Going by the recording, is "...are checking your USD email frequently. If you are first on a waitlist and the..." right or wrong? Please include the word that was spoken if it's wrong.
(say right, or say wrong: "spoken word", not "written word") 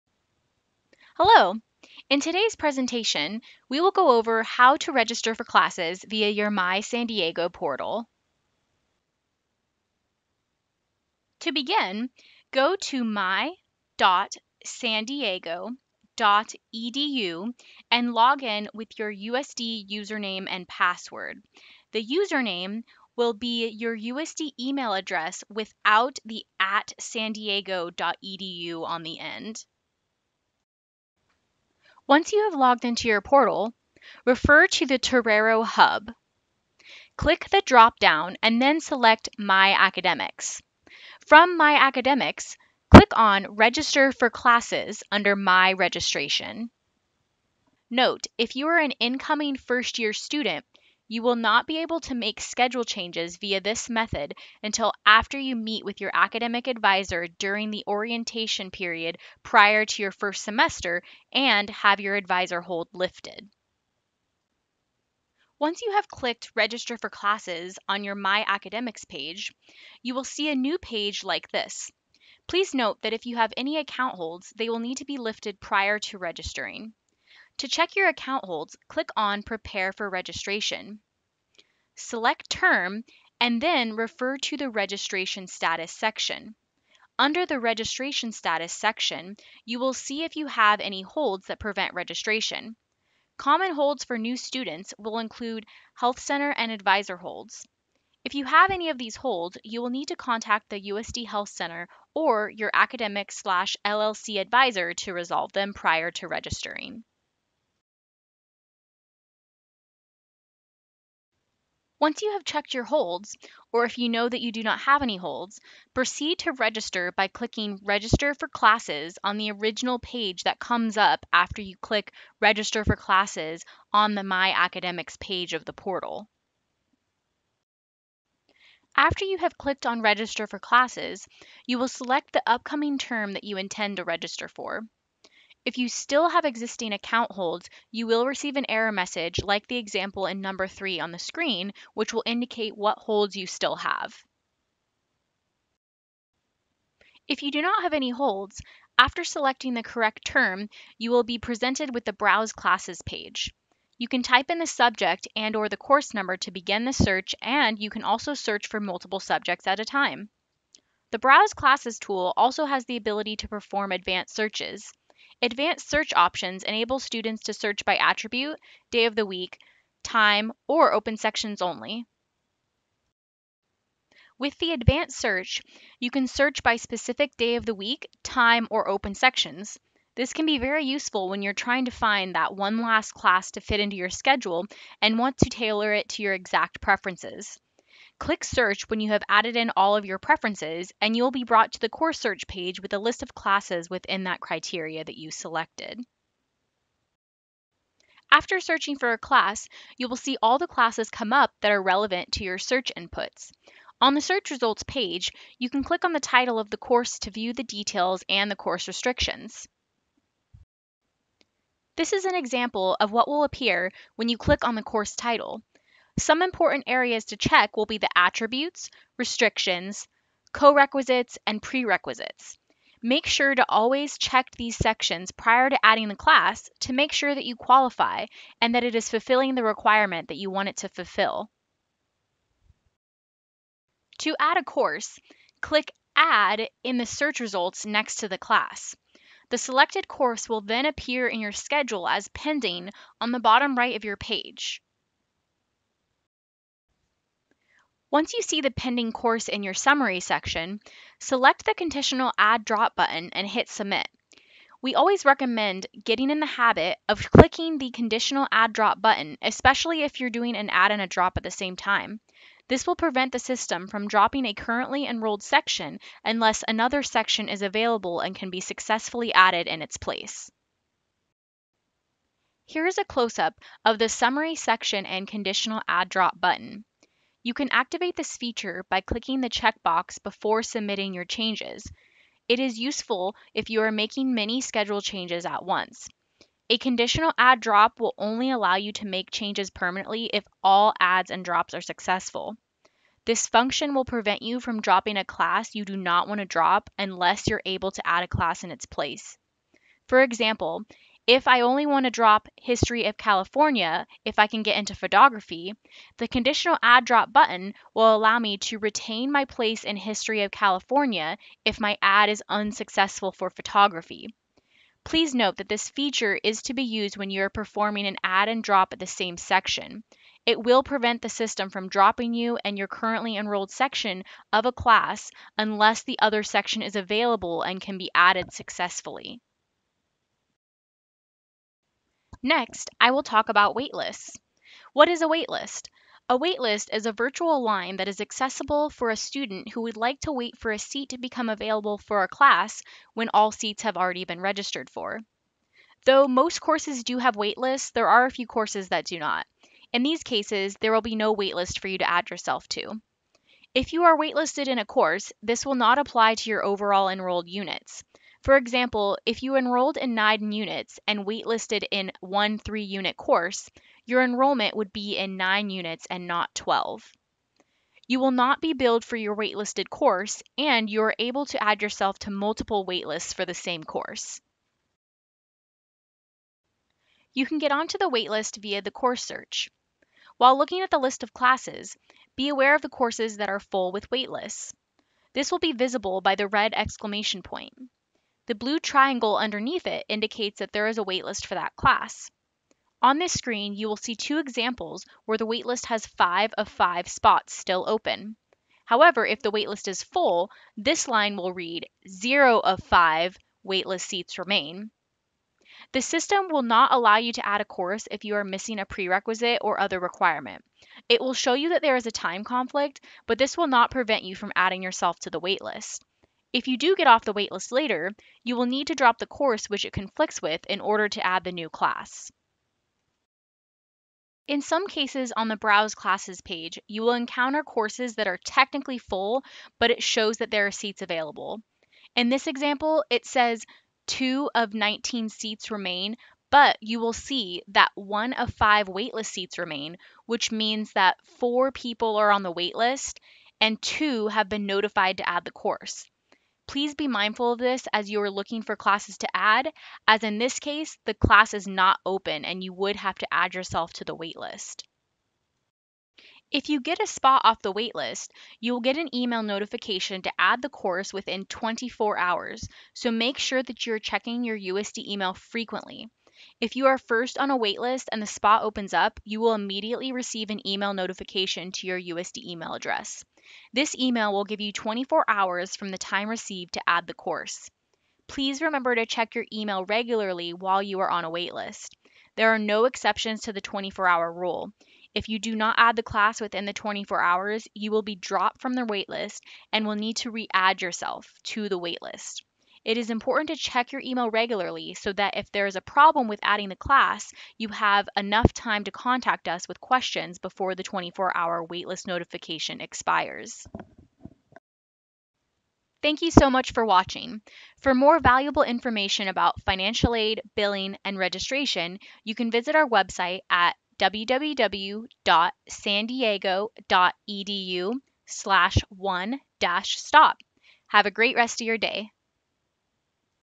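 right.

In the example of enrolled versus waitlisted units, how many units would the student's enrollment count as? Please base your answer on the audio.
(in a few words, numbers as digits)
9.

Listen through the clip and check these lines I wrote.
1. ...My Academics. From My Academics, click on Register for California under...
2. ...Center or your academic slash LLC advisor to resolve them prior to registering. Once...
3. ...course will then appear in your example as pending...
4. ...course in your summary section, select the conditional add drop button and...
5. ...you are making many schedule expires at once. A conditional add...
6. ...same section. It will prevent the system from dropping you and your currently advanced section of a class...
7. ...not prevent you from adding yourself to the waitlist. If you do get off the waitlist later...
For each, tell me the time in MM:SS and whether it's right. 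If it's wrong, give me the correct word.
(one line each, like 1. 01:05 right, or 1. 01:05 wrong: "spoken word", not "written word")
1. 00:39 wrong: "Classes", not "California"
2. 01:41 right
3. 04:00 wrong: "schedule", not "example"
4. 04:09 right
5. 04:43 wrong: "changes", not "expires"
6. 05:19 wrong: "enrolled", not "advanced"
7. 06:53 right.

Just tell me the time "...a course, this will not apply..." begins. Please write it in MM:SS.
05:54.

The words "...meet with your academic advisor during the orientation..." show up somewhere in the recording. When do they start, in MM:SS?
00:55.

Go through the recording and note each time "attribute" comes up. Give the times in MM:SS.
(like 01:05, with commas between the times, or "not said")
02:47, 03:38.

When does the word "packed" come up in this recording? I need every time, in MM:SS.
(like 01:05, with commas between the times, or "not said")
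not said.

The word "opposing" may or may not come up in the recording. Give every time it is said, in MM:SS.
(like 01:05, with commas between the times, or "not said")
not said.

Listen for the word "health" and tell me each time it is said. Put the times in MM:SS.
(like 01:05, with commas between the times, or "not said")
01:35, 01:41.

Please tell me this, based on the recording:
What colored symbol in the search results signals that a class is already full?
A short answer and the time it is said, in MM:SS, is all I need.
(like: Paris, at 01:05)
red exclamation point, at 06:26.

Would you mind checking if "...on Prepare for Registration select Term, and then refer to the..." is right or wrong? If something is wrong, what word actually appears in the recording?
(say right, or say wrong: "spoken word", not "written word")
right.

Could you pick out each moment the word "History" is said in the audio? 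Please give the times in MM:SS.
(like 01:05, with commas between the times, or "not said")
05:02, 05:09.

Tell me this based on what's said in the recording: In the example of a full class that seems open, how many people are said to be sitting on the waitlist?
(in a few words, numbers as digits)
4.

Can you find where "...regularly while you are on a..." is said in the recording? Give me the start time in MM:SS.
07:59.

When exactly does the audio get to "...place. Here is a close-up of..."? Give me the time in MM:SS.
04:29.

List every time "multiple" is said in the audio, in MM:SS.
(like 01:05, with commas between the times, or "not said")
02:38, 06:12.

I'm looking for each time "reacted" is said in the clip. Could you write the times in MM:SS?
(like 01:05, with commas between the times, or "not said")
not said.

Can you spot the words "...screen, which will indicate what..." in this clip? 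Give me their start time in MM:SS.
02:21.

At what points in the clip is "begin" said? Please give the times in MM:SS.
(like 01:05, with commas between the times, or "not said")
00:11, 02:36.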